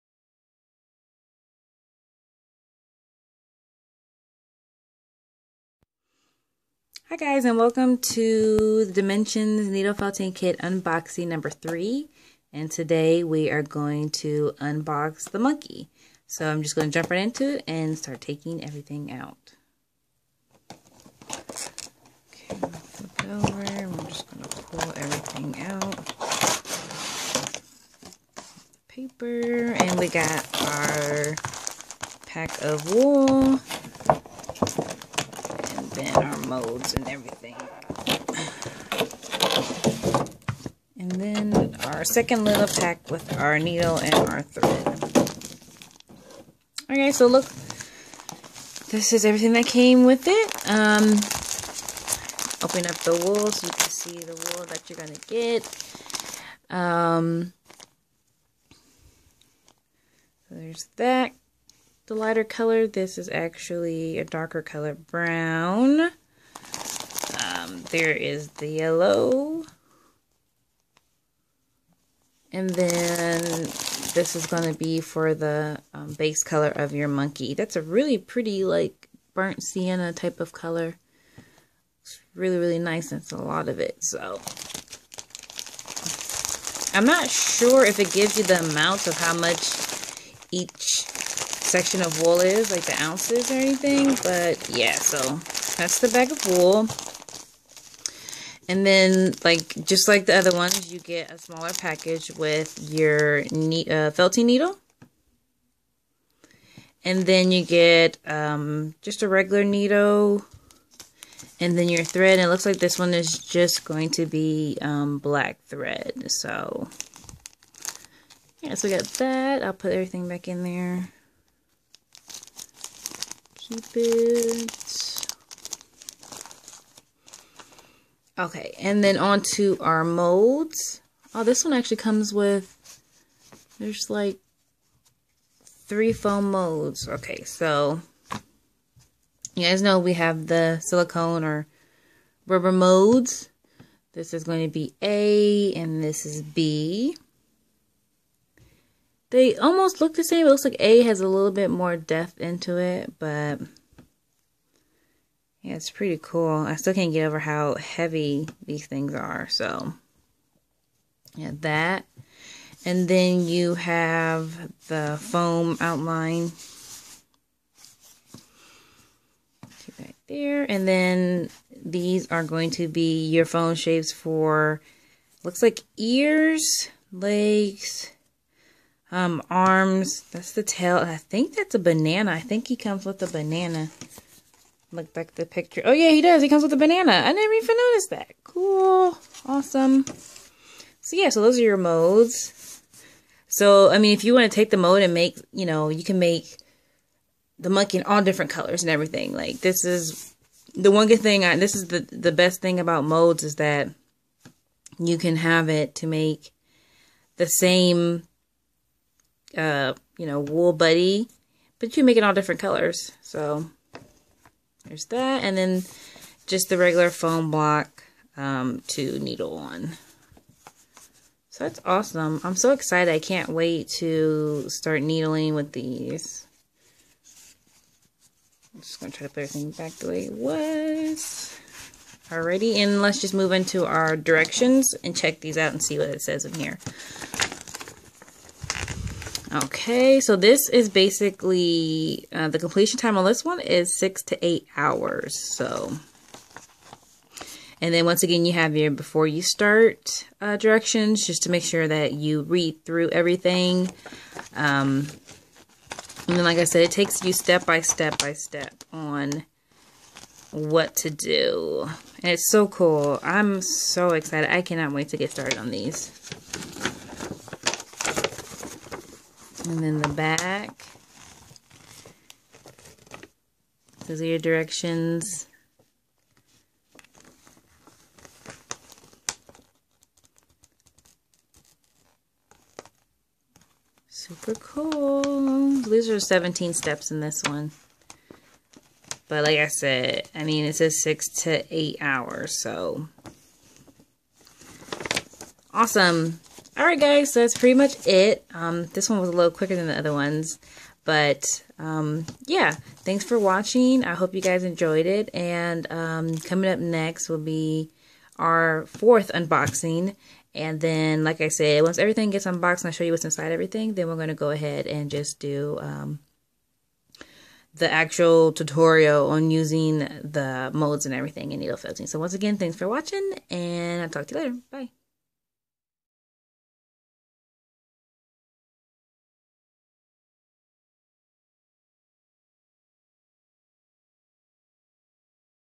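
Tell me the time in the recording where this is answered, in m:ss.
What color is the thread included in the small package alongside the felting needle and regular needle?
1:55.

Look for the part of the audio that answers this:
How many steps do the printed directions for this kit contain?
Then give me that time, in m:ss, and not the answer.
4:46.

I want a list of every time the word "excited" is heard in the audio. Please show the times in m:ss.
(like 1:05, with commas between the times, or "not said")
3:42, 4:24.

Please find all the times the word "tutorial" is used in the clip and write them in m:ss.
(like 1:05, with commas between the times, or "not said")
5:18.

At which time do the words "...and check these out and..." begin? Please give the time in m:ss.
3:55.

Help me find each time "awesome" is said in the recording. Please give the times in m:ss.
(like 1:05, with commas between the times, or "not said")
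3:09, 3:41, 4:55.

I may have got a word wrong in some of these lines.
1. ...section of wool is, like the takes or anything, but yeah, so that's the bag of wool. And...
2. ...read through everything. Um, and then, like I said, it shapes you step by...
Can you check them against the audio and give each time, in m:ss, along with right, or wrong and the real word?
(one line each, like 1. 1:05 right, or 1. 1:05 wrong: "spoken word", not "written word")
1. 1:31 wrong: "ounces", not "takes"
2. 4:12 wrong: "takes", not "shapes".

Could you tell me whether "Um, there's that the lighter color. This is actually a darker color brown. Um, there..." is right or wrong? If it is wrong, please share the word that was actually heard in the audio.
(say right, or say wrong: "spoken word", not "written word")
right.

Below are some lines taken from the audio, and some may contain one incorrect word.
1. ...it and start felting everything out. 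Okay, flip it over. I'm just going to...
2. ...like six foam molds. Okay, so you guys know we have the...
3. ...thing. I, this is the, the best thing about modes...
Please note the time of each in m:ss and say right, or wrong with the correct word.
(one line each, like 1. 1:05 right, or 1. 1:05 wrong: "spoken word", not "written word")
1. 0:17 wrong: "taking", not "felting"
2. 2:14 wrong: "three", not "six"
3. 3:21 right.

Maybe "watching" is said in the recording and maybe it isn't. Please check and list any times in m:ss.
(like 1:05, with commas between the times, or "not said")
5:03, 5:22.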